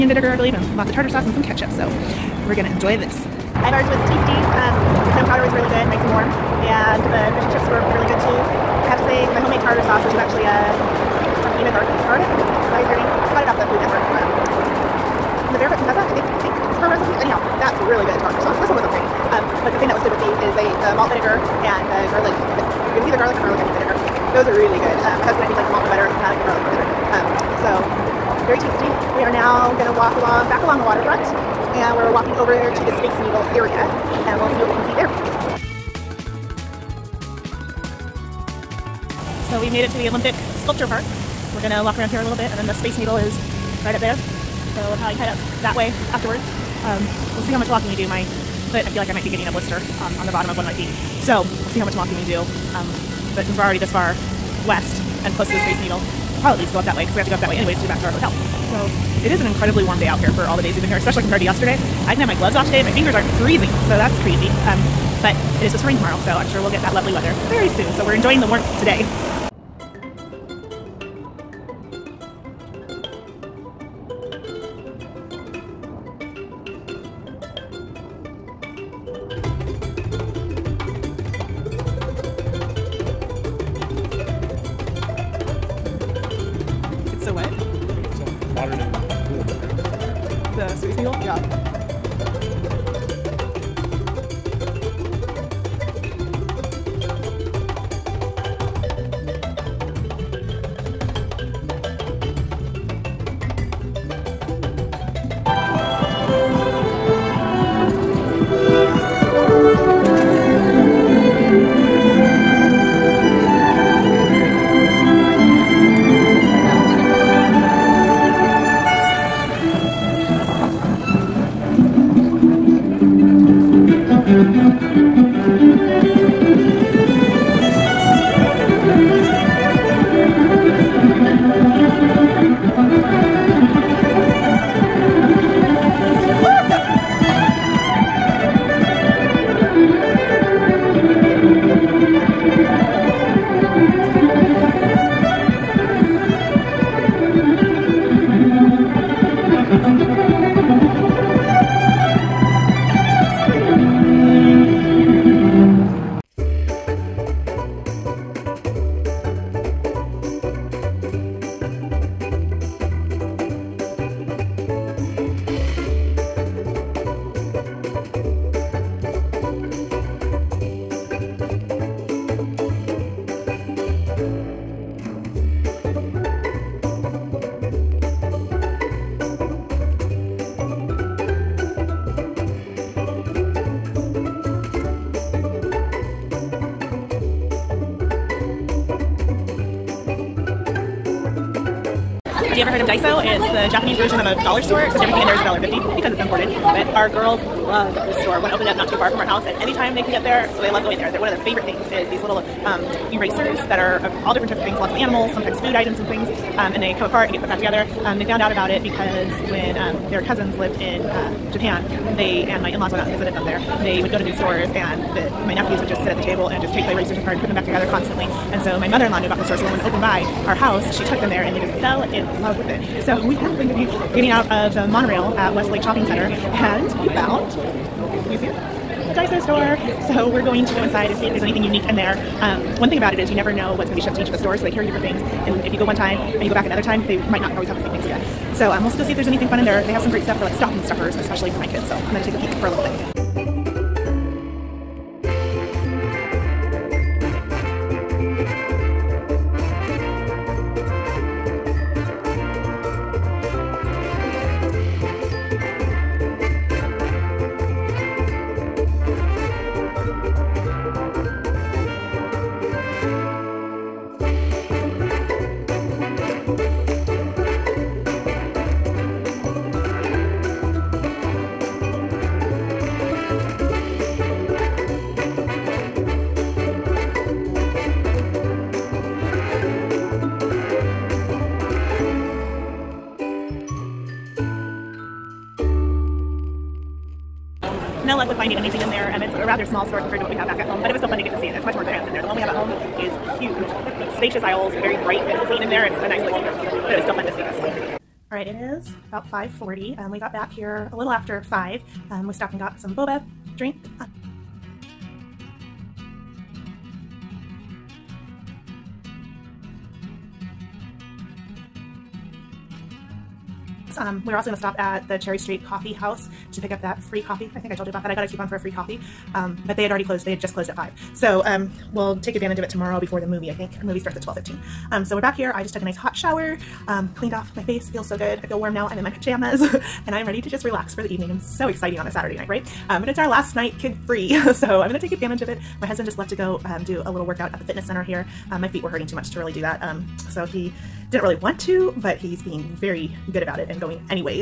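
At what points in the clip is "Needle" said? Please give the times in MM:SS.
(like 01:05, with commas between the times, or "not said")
00:33, 00:42, 00:55.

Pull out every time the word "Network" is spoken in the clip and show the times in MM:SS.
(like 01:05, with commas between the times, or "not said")
00:13.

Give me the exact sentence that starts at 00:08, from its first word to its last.
I have to say my homemade tartar sauce, which is actually uh, from Ina Garden, Garden?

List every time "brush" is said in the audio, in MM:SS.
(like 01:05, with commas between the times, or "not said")
not said.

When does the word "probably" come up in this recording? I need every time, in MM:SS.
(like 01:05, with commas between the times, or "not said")
00:45, 00:56.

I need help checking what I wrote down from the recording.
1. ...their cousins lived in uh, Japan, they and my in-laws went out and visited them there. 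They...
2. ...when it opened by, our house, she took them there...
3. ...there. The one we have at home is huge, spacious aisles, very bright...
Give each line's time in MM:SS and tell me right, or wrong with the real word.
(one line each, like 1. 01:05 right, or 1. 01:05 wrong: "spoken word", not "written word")
1. 03:30 right
2. 03:39 right
3. 04:52 right.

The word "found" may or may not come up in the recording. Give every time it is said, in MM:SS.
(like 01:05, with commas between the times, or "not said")
03:28, 03:47.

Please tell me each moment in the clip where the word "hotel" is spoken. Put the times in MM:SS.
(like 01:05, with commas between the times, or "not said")
00:58.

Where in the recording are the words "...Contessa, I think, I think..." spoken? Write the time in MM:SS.
00:15.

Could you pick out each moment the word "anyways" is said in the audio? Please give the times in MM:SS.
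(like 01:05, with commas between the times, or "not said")
00:57.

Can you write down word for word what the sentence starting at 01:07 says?
So we're enjoying the warmth today.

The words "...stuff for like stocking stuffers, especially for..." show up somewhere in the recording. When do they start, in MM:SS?
04:00.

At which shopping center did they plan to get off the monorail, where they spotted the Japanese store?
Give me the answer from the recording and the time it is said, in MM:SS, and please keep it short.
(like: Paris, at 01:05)
Westlake Shopping Center, at 03:45.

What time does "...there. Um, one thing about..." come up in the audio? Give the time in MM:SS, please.
03:51.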